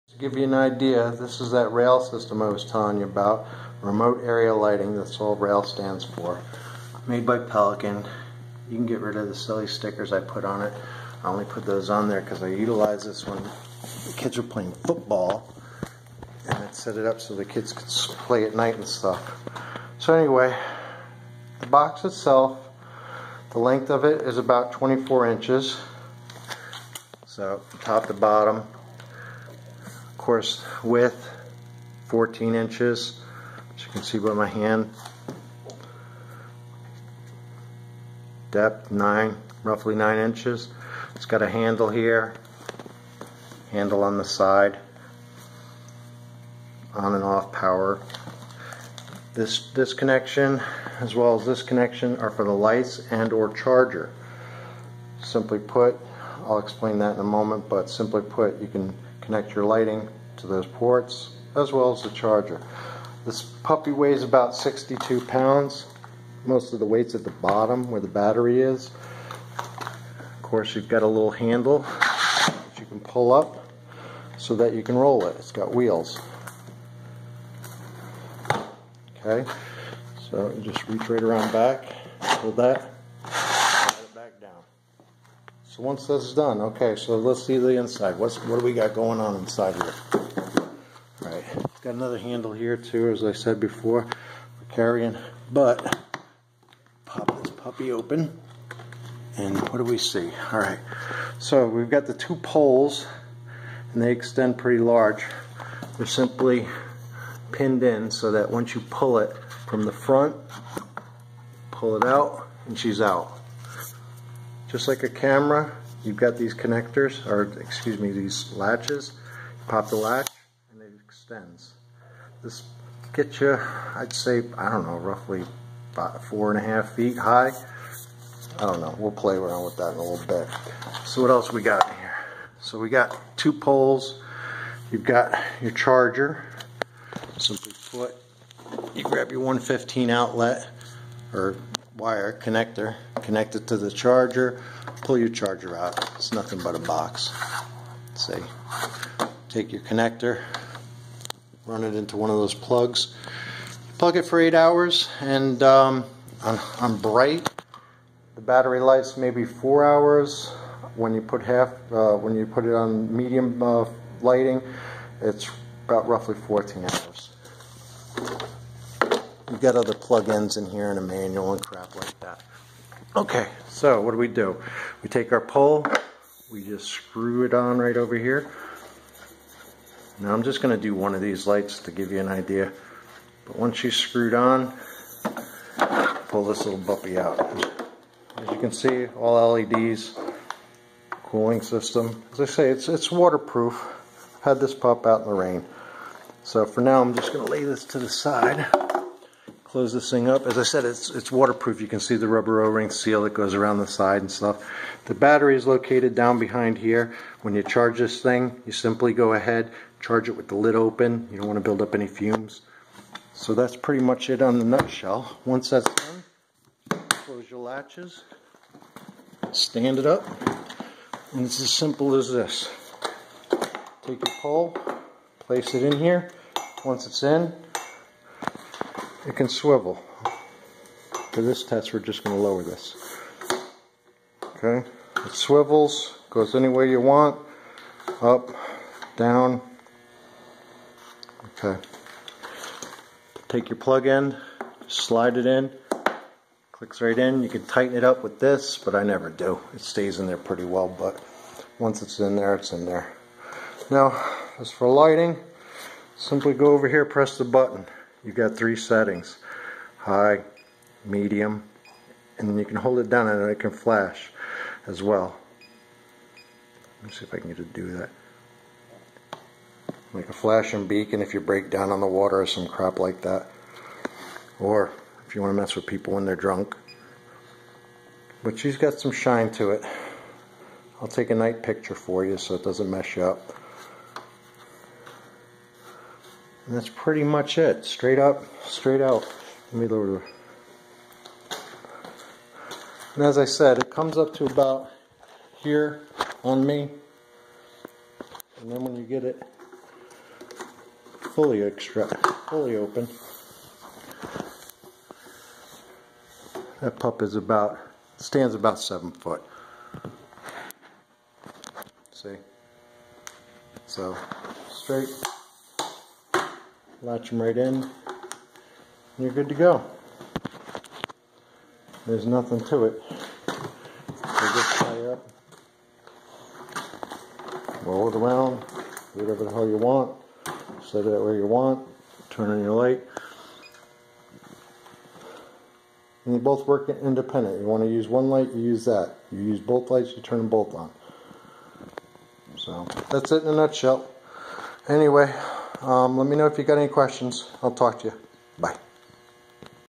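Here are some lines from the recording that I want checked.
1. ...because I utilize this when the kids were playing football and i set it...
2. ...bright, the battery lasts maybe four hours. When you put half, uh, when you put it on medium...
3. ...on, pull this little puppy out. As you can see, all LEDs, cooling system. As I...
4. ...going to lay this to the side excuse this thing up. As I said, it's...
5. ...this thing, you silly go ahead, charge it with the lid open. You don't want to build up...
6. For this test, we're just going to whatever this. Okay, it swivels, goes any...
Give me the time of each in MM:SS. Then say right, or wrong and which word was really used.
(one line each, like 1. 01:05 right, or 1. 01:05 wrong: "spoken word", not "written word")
1. 00:12 right
2. 02:36 right
3. 03:04 right
4. 03:17 wrong: "close", not "excuse"
5. 03:27 wrong: "simply", not "silly"
6. 03:51 wrong: "lower", not "whatever".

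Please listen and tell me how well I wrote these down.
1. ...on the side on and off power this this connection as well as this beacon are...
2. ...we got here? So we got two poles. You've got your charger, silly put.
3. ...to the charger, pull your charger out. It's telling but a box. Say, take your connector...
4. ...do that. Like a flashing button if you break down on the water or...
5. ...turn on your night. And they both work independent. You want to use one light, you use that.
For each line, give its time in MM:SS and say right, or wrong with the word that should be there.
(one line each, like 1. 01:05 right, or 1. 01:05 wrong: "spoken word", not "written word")
1. 00:44 wrong: "connection", not "beacon"
2. 02:11 wrong: "simply", not "silly"
3. 02:23 wrong: "nothing", not "telling"
4. 04:27 wrong: "beacon", not "button"
5. 05:32 wrong: "light", not "night".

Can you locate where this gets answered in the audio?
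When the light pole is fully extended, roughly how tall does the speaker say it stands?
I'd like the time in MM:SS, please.
05:08.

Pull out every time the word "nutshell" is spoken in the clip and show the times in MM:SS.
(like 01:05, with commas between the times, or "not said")
03:34, 05:43.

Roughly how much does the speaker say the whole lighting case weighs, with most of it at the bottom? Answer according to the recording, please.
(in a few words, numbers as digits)
62 pounds.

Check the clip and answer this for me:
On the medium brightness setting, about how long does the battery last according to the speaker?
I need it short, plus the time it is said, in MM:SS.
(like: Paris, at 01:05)
14 hours, at 02:46.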